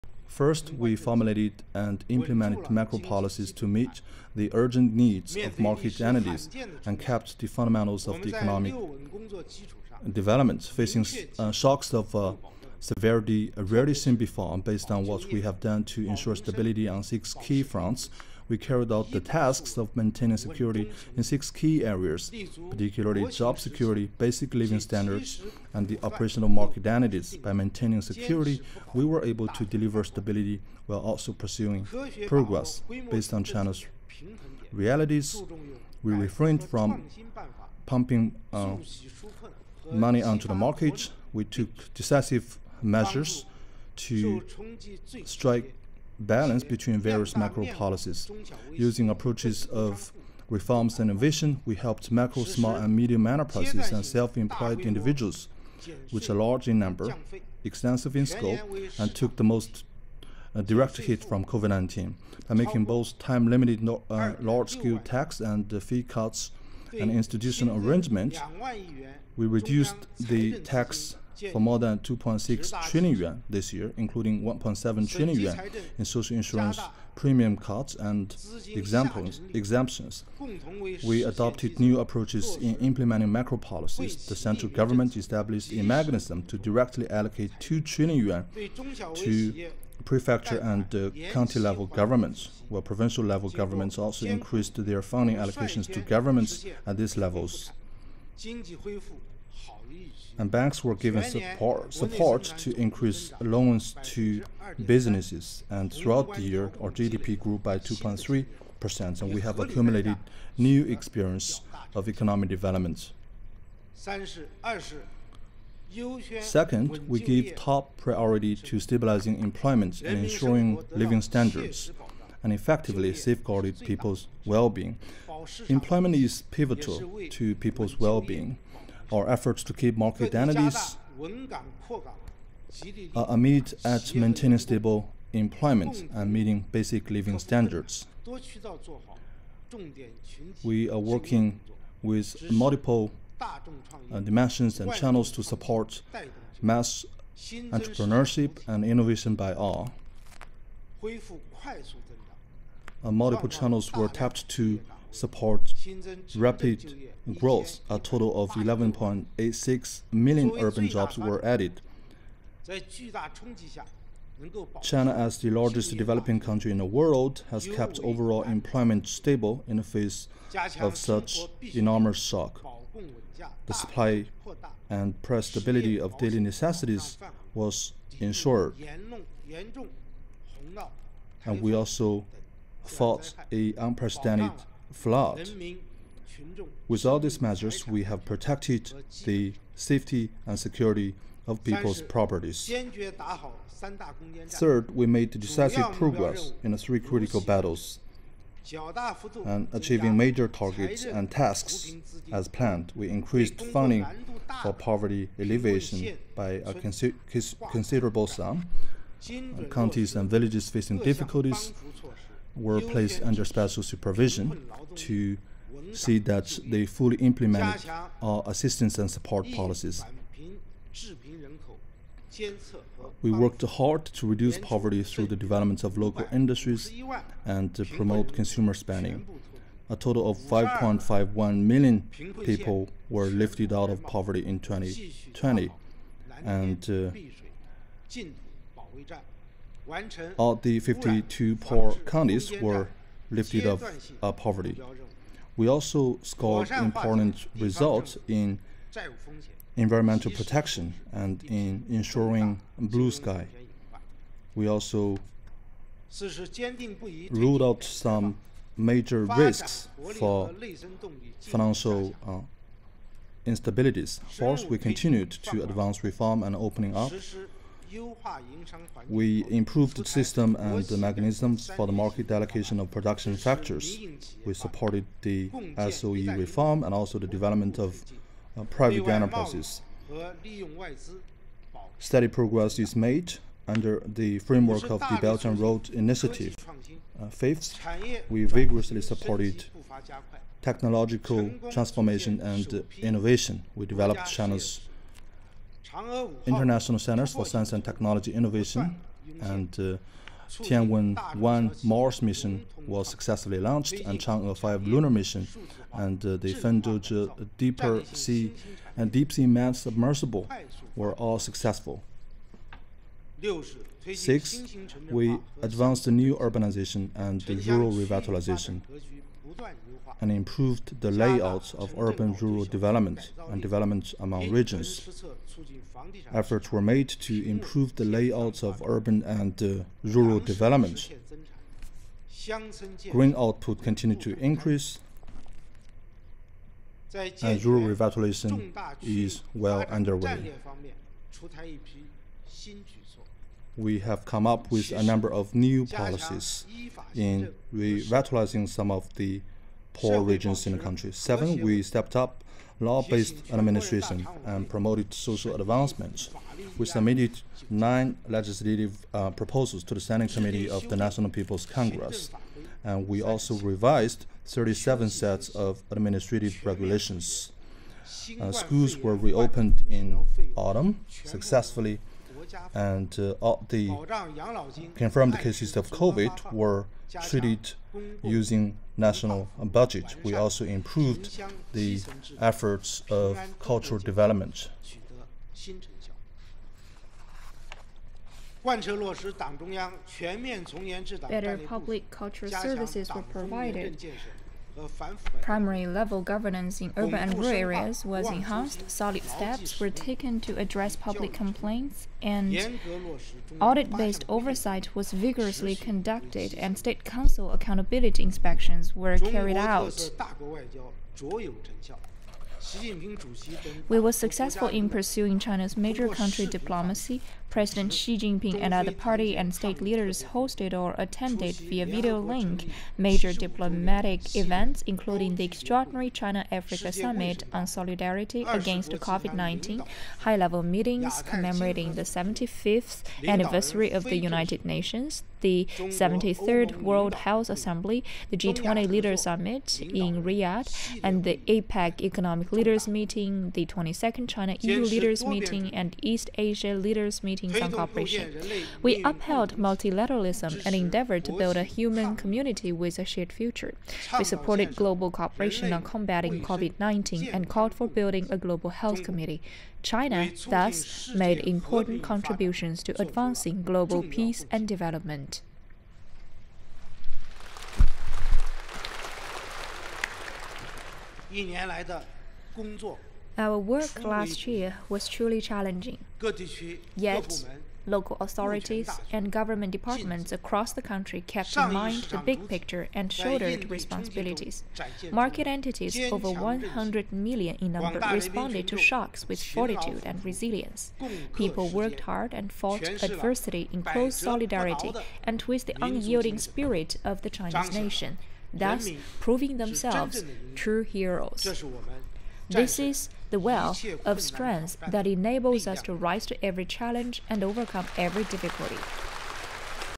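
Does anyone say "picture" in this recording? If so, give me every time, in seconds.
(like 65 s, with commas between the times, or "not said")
482 s.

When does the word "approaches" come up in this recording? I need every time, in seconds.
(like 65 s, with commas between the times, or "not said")
49 s, 81 s.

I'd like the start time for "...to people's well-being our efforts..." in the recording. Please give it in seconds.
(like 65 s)
127 s.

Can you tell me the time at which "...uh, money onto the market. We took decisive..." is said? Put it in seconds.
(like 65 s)
38 s.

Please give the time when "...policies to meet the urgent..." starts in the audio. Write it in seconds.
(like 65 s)
2 s.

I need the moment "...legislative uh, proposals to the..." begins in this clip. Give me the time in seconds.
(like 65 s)
358 s.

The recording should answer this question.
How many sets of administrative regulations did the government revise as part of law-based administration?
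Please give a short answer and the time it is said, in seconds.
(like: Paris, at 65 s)
37, at 364 s.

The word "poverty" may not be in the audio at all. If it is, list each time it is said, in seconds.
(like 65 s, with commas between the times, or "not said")
204 s, 224 s, 234 s, 244 s.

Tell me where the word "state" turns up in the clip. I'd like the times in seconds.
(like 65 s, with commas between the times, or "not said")
406 s, 419 s.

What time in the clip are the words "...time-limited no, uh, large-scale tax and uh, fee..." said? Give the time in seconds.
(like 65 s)
63 s.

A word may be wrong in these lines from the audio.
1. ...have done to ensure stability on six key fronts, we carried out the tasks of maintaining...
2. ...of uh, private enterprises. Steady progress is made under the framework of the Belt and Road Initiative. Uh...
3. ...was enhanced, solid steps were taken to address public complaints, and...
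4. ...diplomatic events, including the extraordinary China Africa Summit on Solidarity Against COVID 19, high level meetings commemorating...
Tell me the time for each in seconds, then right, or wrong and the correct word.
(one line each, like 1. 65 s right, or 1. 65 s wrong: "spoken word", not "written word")
1. 15 s right
2. 277 s right
3. 398 s right
4. 423 s right.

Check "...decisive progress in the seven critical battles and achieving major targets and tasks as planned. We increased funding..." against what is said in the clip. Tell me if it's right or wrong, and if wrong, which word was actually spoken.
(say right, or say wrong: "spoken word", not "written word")
wrong: "three", not "seven".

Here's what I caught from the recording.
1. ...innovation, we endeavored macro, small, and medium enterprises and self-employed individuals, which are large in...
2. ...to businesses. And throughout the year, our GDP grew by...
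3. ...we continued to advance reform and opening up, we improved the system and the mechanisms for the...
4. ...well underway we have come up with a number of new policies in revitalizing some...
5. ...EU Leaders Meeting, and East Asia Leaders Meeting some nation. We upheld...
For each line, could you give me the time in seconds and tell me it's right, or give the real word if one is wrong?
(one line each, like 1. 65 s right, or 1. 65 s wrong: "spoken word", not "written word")
1. 51 s wrong: "helped", not "endeavored"
2. 104 s right
3. 264 s right
4. 339 s right
5. 444 s wrong: "cooperation", not "nation".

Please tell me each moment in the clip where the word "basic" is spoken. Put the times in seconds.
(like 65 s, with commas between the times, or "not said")
24 s, 136 s.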